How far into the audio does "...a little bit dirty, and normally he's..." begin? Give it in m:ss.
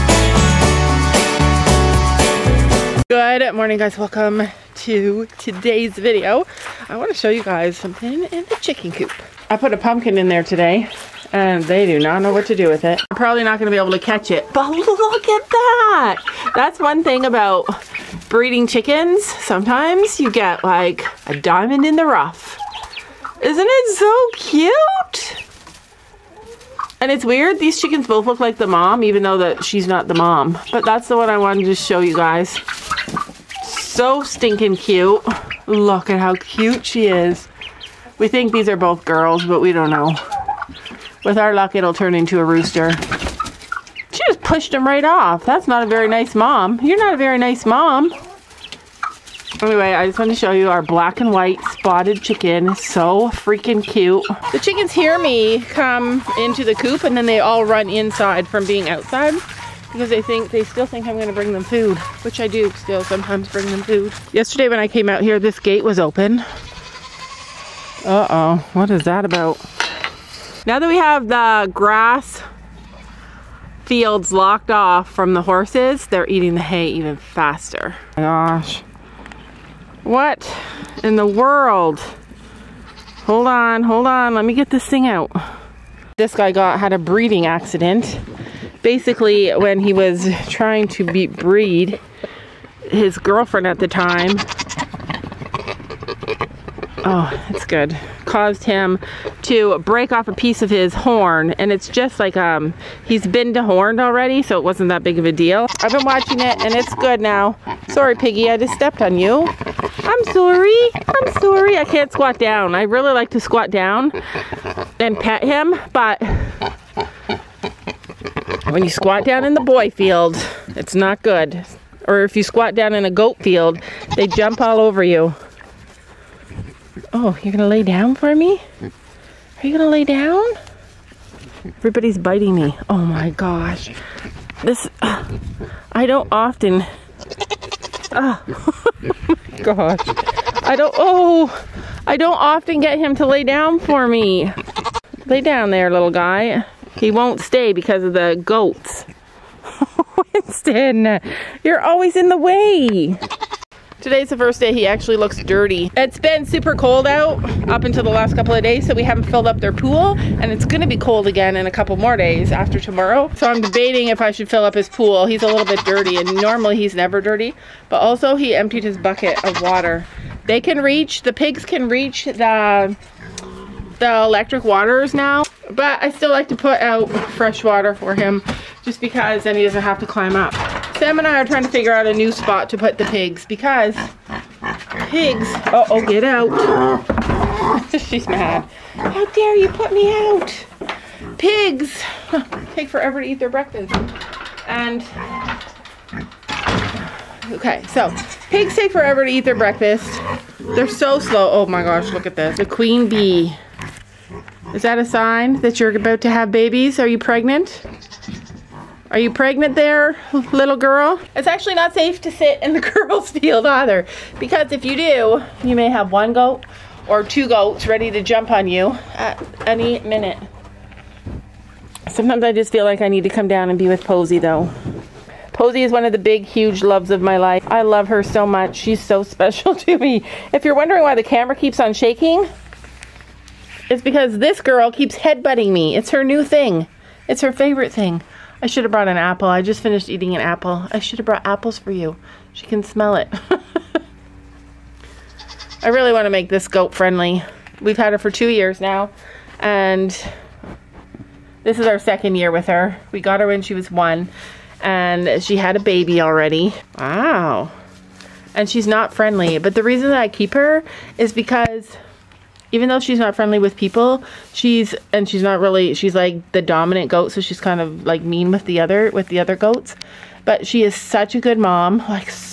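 2:45.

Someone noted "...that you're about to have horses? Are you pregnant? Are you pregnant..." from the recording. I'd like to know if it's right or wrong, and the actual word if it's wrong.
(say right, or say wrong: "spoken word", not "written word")
wrong: "babies", not "horses".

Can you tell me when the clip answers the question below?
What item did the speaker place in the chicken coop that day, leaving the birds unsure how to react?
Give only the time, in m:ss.
0:09.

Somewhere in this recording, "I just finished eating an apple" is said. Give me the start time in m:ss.
3:59.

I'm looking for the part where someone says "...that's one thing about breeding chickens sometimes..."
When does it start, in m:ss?
0:16.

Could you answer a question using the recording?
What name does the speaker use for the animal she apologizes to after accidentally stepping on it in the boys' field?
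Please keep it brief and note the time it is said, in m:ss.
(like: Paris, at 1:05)
Piggy, at 1:48.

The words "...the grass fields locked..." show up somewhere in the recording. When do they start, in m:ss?
1:11.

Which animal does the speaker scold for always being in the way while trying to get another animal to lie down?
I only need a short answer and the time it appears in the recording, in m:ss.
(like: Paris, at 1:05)
Winston, at 2:30.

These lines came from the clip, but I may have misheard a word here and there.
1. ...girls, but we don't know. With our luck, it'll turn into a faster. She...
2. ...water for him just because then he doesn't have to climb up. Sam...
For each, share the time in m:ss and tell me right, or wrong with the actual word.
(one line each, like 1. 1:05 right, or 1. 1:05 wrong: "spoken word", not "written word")
1. 0:39 wrong: "rooster", not "faster"
2. 2:57 right.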